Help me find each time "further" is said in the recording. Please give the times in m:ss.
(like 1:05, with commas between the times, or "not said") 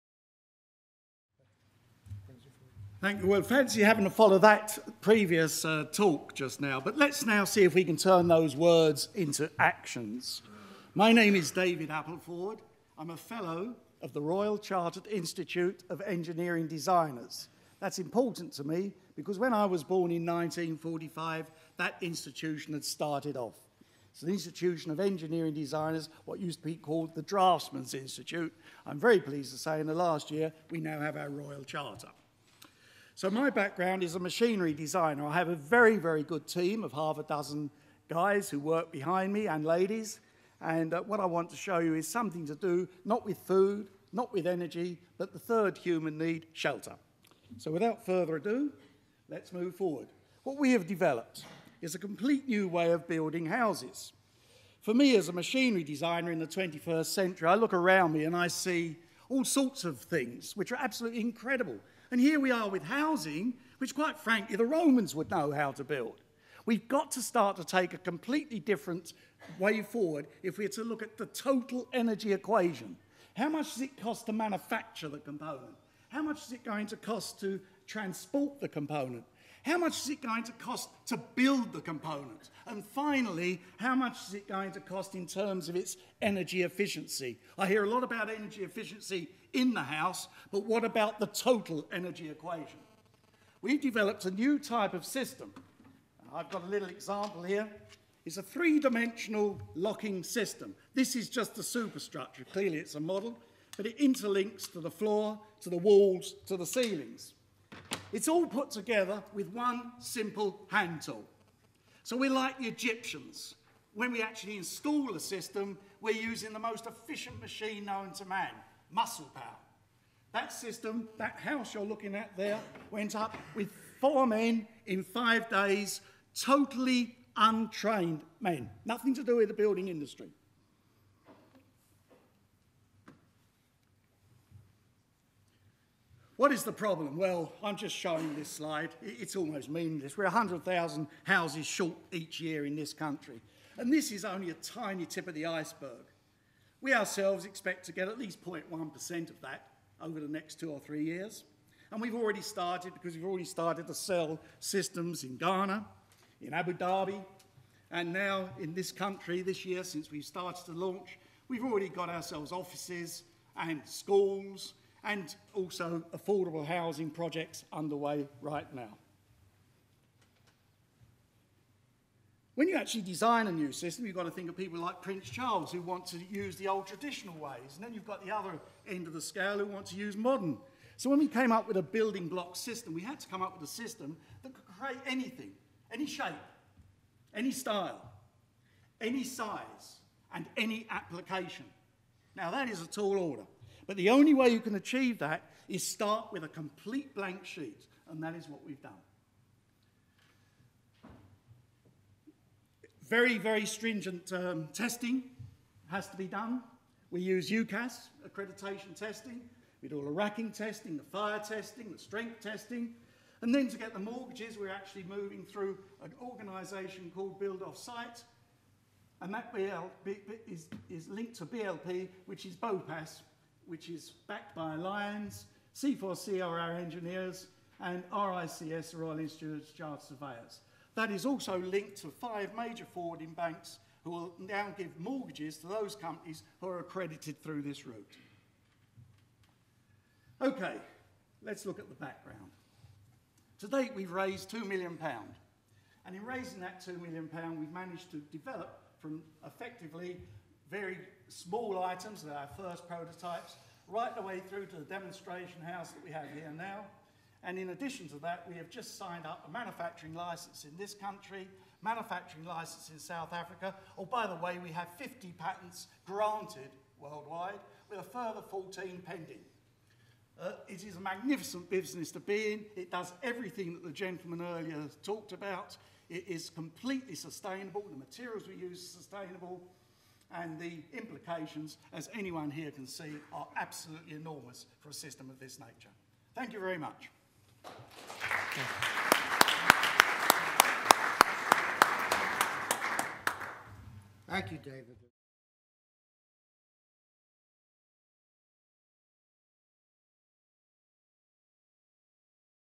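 0:48, 4:28.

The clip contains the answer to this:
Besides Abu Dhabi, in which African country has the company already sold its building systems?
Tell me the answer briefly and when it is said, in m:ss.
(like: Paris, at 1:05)
Ghana, at 2:35.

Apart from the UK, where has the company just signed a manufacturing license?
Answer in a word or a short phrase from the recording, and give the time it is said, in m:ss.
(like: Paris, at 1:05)
South Africa, at 4:22.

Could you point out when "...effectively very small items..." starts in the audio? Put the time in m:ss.
4:09.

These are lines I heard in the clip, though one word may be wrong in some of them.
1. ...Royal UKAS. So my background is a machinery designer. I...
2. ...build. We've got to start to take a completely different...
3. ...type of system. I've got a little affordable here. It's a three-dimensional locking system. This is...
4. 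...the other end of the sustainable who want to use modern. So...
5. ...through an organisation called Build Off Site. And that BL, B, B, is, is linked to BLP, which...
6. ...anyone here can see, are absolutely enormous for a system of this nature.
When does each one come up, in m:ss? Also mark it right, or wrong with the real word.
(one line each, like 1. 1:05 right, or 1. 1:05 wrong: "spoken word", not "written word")
1. 0:31 wrong: "Charter", not "UKAS"
2. 1:05 right
3. 1:34 wrong: "example", not "affordable"
4. 2:58 wrong: "scale", not "sustainable"
5. 3:35 right
6. 4:42 right.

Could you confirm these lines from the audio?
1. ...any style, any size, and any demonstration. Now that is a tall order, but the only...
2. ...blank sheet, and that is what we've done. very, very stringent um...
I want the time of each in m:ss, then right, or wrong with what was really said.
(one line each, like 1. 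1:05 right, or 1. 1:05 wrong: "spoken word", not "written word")
1. 3:07 wrong: "application", not "demonstration"
2. 3:17 right.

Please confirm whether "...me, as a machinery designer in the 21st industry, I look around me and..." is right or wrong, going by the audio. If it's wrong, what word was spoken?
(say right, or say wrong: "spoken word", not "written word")
wrong: "century", not "industry".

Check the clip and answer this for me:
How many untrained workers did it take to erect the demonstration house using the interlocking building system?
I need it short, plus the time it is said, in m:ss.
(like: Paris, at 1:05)
4, at 2:03.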